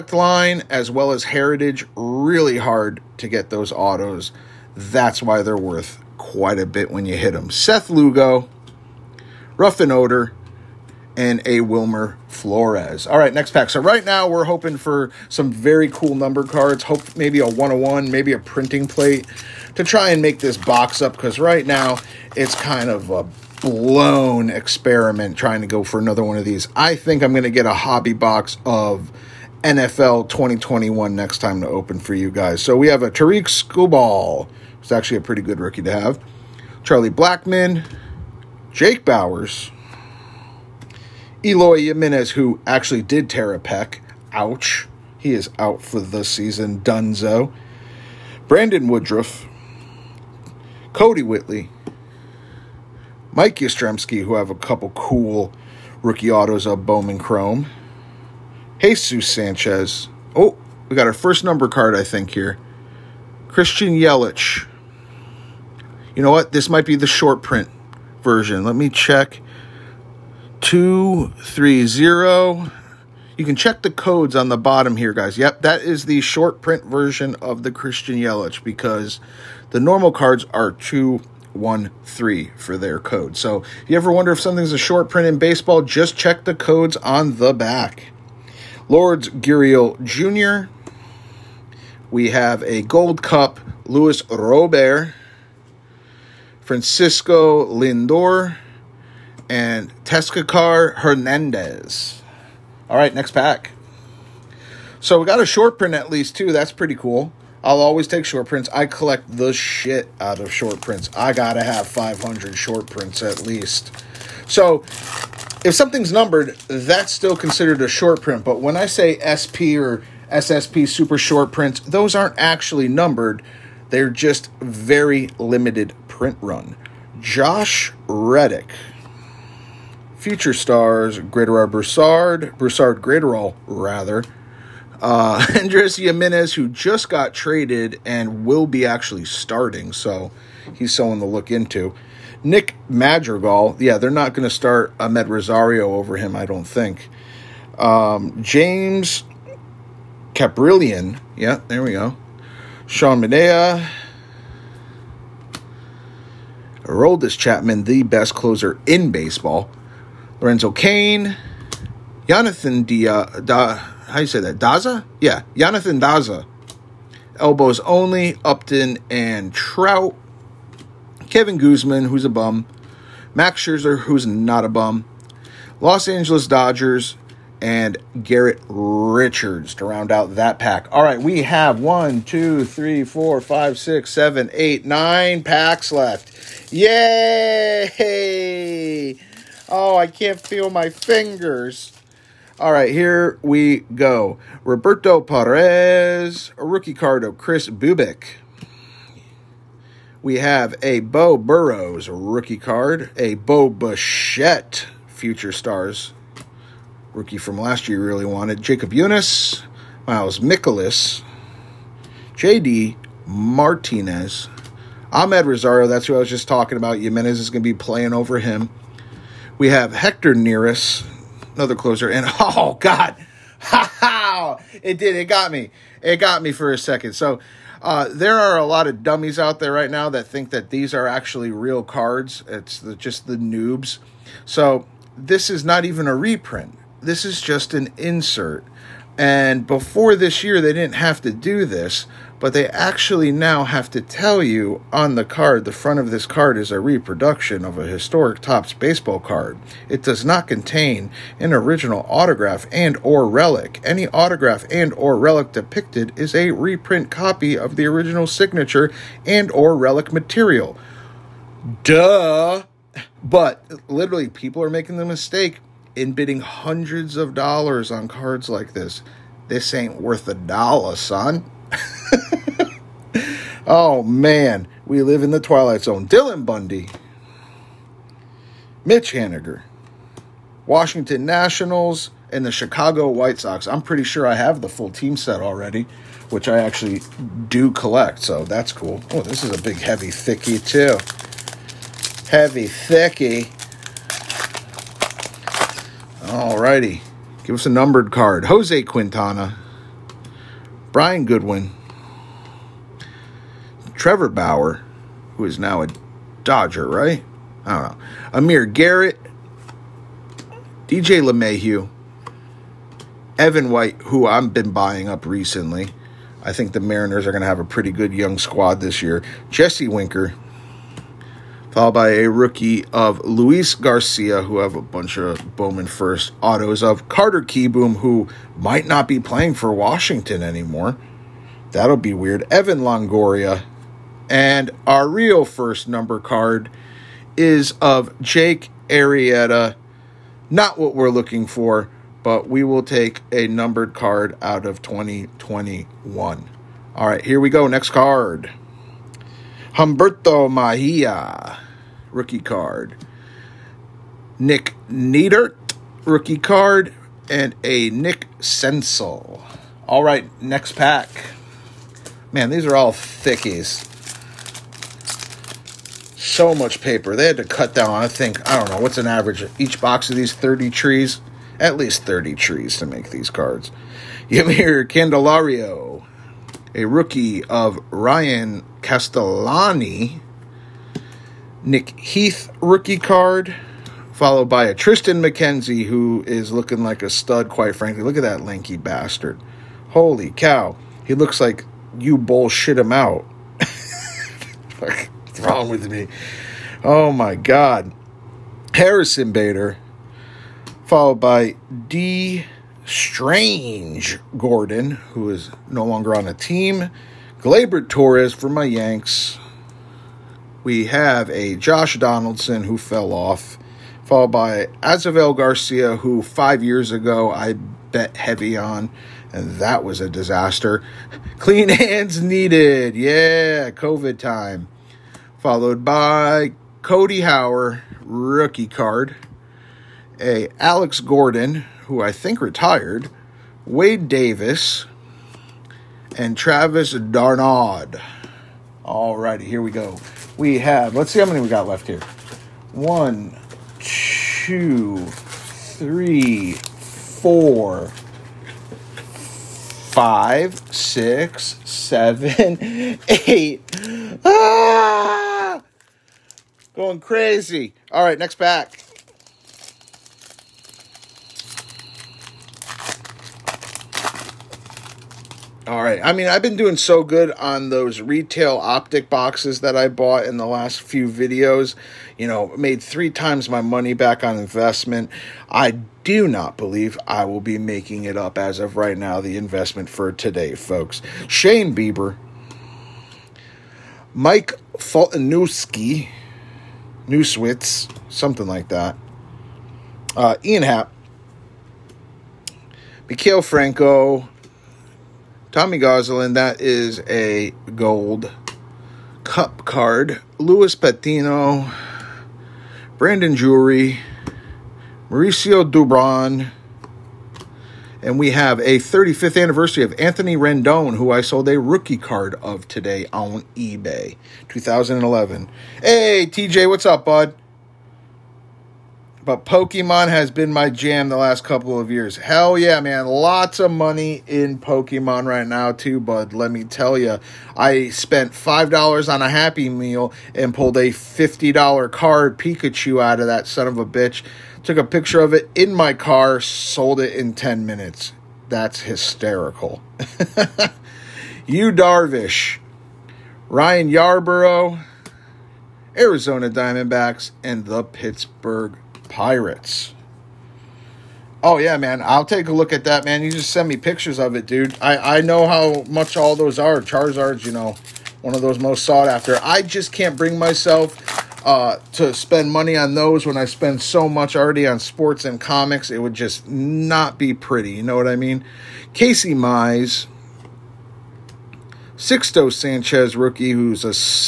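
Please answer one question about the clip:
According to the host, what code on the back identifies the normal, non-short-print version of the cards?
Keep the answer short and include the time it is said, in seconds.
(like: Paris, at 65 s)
213, at 80 s.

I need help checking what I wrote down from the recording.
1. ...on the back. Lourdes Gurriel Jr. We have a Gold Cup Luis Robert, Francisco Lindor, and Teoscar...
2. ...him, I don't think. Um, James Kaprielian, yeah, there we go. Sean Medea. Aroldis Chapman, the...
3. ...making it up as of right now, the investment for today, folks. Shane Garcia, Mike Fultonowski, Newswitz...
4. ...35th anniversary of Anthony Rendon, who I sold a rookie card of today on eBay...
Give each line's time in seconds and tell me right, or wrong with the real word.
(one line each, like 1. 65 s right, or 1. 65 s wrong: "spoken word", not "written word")
1. 86 s right
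2. 146 s right
3. 477 s wrong: "Bieber", not "Garcia"
4. 508 s right.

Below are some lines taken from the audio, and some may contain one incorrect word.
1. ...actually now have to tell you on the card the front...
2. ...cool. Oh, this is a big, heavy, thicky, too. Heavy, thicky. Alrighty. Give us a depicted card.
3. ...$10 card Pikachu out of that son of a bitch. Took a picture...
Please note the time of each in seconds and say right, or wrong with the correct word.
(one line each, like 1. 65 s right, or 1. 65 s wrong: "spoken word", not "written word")
1. 242 s right
2. 288 s wrong: "numbered", not "depicted"
3. 530 s wrong: "50", not "10".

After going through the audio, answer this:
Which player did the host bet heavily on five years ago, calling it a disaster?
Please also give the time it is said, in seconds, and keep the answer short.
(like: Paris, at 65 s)
Avisail Garcia, at 414 s.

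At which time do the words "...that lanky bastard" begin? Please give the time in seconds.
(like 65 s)
388 s.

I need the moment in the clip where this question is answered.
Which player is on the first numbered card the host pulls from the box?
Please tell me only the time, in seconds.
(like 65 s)
338 s.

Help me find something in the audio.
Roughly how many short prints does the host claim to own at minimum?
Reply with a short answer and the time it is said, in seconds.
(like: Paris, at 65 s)
500, at 111 s.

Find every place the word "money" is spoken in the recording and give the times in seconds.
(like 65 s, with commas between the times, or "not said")
473 s, 523 s, 562 s.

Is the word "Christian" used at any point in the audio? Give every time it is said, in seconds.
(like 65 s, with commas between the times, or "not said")
63 s, 77 s.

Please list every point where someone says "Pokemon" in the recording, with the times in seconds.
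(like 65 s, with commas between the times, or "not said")
519 s, 524 s.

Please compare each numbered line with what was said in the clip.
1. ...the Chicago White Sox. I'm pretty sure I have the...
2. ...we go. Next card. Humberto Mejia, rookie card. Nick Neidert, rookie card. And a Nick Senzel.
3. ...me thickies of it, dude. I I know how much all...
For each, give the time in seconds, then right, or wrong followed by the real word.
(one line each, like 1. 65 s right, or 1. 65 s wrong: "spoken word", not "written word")
1. 282 s right
2. 347 s right
3. 553 s wrong: "pictures", not "thickies".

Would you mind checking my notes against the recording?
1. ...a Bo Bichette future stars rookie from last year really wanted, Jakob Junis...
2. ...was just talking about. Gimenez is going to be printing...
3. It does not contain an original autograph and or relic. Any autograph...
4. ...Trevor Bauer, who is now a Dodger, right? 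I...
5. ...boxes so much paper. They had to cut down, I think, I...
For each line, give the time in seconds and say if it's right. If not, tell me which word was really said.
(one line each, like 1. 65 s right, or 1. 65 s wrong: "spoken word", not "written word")
1. 203 s right
2. 216 s wrong: "playing", not "printing"
3. 249 s right
4. 304 s right
5. 362 s wrong: "thickies", not "boxes".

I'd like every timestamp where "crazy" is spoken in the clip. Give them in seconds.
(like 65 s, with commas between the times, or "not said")
456 s.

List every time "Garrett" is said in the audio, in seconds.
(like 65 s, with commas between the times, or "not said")
178 s, 308 s.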